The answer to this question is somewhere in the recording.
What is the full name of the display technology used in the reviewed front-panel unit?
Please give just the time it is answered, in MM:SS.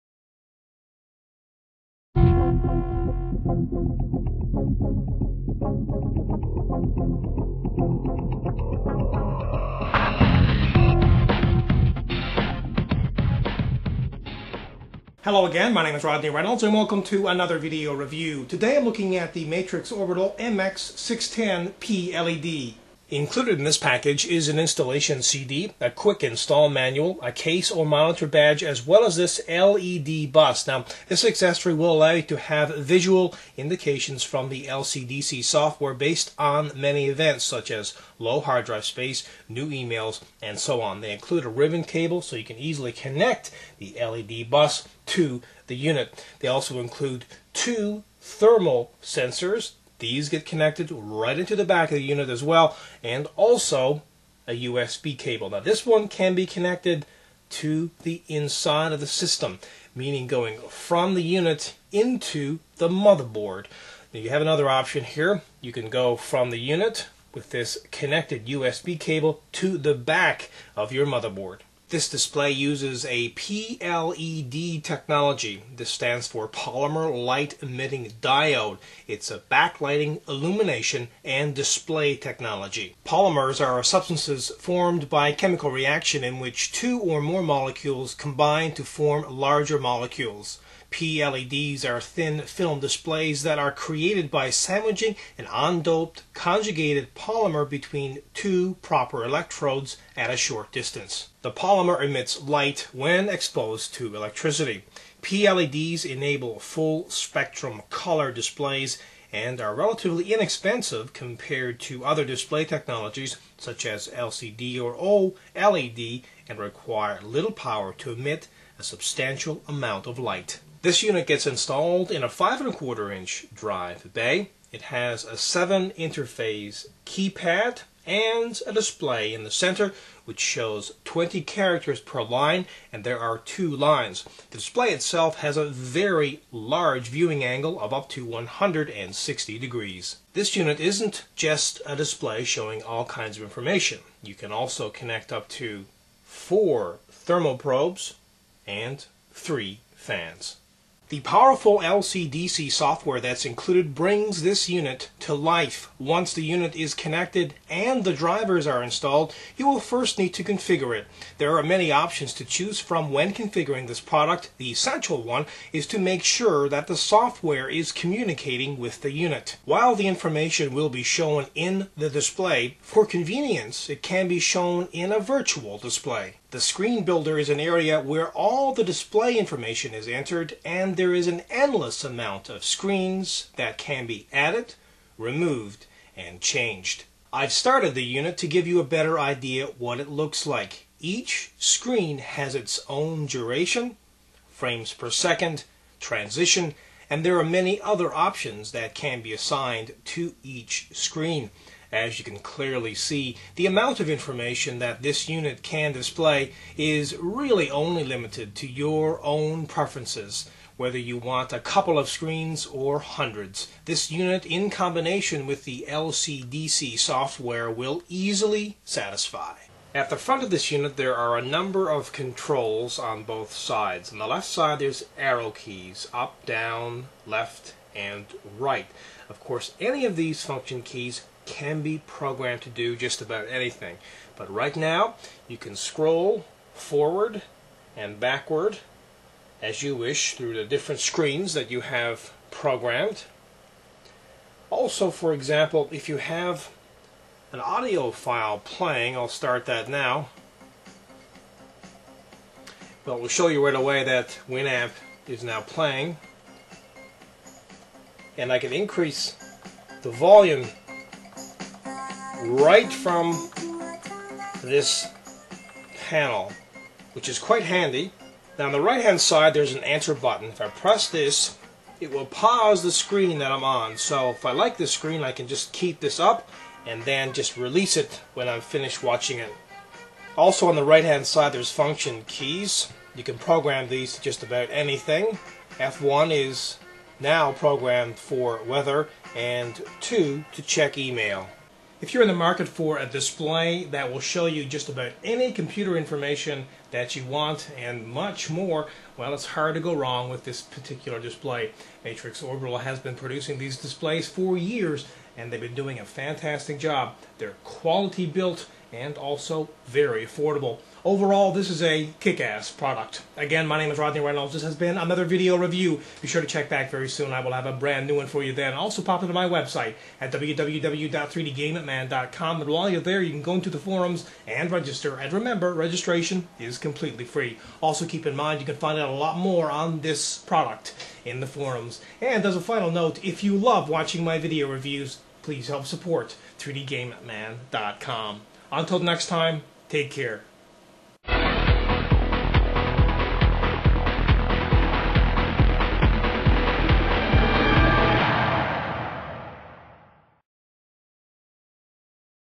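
01:16.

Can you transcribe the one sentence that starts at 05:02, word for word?
Matrix Orbital has been producing these displays for years, and they've been doing a fantastic job.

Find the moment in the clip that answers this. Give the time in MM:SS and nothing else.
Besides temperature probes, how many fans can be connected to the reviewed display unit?
02:29.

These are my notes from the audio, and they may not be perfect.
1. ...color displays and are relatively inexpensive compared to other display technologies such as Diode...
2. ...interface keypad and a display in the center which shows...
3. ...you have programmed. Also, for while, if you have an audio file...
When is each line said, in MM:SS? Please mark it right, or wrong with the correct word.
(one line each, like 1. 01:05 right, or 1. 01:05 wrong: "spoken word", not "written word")
1. 01:47 wrong: "LCD", not "Diode"
2. 02:05 right
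3. 04:01 wrong: "example", not "while".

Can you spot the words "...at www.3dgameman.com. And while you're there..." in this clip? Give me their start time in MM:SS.
05:20.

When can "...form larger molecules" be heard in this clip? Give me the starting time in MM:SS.
01:28.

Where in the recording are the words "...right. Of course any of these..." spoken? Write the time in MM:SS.
03:48.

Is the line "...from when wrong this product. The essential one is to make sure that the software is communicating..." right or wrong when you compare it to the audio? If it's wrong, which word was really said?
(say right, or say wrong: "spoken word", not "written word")
wrong: "configuring", not "wrong".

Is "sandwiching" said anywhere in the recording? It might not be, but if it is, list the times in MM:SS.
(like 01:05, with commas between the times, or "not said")
01:34.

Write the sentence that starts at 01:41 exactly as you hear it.
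The polymer emits light when exposed to electricity.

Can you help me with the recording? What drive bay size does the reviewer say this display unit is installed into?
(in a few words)
5 and a quarter inch.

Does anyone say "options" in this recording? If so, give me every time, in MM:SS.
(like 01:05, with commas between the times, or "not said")
01:04, 02:41, 03:18.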